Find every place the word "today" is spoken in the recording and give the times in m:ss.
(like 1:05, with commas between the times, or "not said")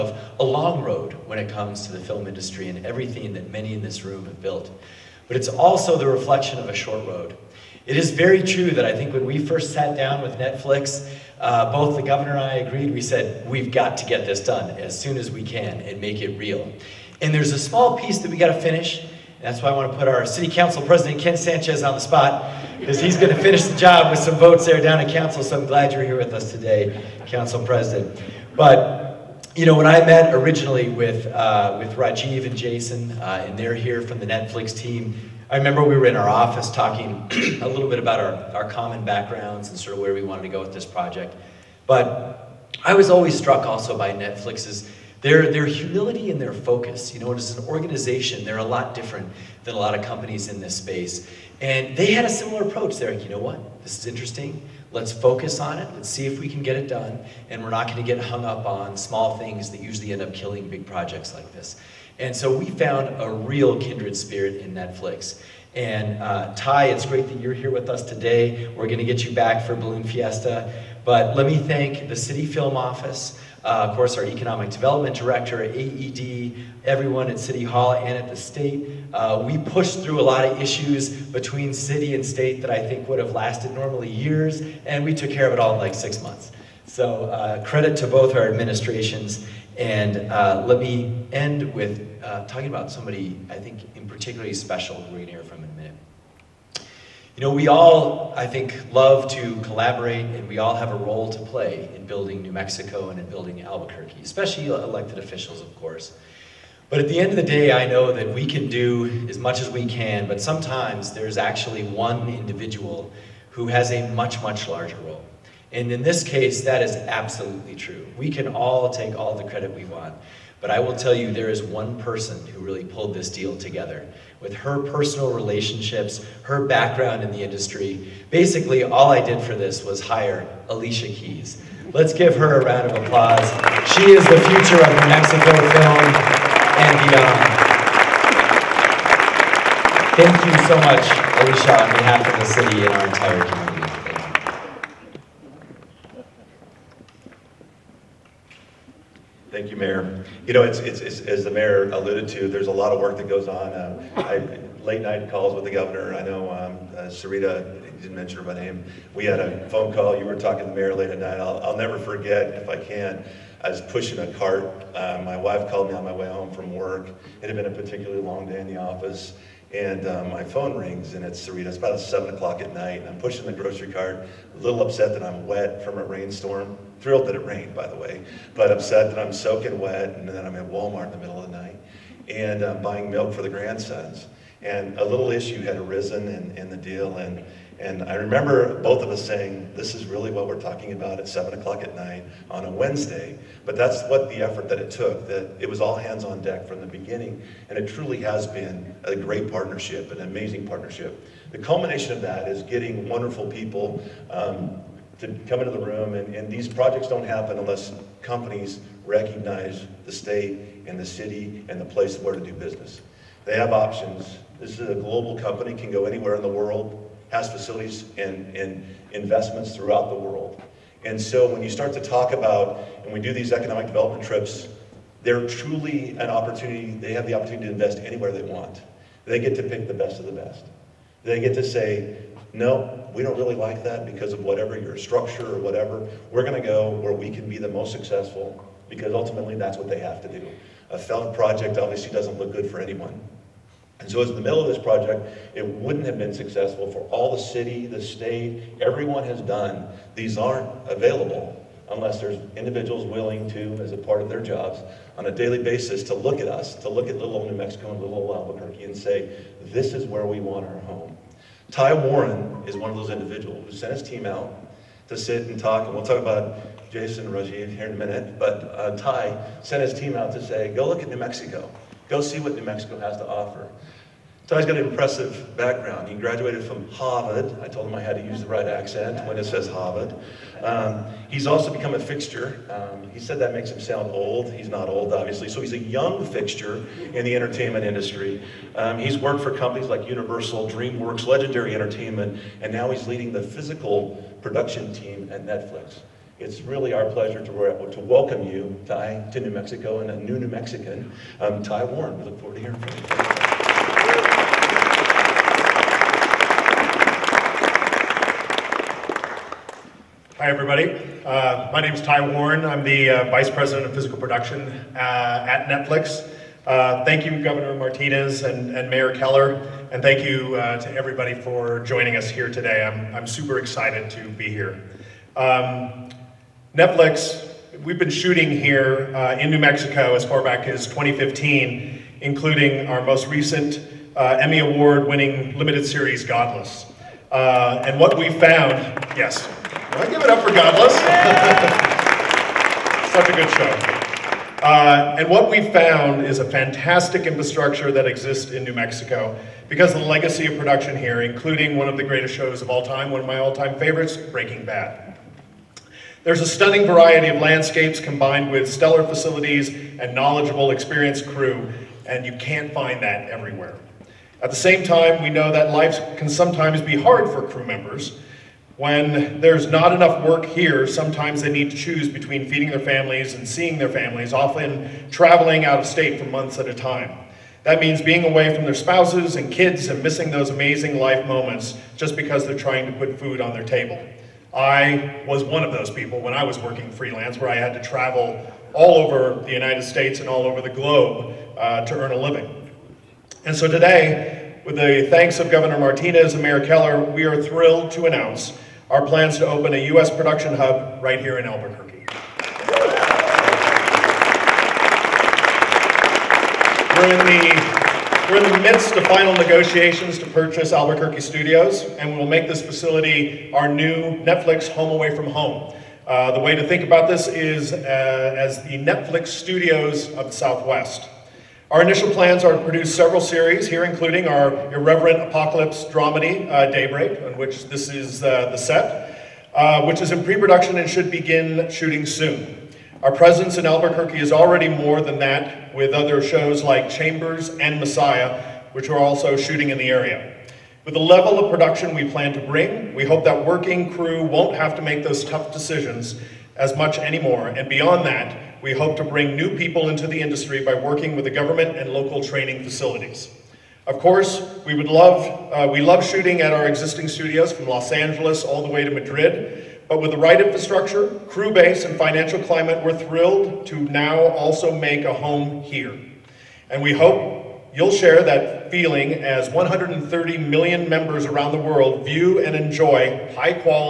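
0:26, 1:08, 5:22, 6:33.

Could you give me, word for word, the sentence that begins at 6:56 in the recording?
Uh, the way to think about this is uh, as the Netflix studios of the Southwest.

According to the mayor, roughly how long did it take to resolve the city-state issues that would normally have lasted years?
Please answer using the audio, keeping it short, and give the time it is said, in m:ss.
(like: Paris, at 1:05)
6 months, at 1:25.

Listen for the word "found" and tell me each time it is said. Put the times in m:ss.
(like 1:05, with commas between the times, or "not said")
1:02, 5:38, 5:45.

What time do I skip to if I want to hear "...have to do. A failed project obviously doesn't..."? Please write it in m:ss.
3:59.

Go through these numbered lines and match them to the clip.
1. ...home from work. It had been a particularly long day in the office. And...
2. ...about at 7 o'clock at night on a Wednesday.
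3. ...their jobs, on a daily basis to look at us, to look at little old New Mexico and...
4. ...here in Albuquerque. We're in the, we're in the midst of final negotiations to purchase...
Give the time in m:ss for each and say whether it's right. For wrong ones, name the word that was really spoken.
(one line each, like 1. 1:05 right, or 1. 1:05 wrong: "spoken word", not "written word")
1. 2:46 right
2. 3:10 right
3. 4:14 right
4. 6:41 right.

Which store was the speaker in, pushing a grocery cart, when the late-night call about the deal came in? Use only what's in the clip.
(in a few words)
Walmart.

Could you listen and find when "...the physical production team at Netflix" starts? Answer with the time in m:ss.
4:53.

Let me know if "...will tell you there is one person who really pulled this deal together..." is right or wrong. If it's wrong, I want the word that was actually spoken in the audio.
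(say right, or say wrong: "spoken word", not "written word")
right.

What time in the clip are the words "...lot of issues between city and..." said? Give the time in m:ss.
1:20.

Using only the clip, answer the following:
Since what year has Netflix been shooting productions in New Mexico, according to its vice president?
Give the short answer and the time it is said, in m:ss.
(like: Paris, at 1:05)
2015, at 5:30.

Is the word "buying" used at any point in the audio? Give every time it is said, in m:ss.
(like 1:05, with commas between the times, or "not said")
3:02.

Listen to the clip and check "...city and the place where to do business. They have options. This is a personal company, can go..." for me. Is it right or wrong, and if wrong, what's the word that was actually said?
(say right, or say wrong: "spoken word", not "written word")
wrong: "global", not "personal".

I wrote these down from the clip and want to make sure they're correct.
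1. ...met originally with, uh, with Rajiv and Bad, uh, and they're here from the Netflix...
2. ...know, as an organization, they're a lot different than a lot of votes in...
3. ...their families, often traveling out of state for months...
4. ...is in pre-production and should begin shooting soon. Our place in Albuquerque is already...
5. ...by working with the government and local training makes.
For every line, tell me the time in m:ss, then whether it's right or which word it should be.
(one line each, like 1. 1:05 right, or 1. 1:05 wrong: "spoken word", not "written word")
1. 0:30 wrong: "Jason", not "Bad"
2. 0:47 wrong: "companies", not "votes"
3. 6:13 right
4. 7:09 wrong: "presence", not "place"
5. 7:30 wrong: "facilities", not "makes".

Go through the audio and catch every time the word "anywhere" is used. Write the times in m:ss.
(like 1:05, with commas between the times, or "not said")
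3:36, 3:47.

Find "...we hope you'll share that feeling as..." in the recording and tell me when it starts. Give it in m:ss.
7:46.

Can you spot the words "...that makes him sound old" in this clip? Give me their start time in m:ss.
4:43.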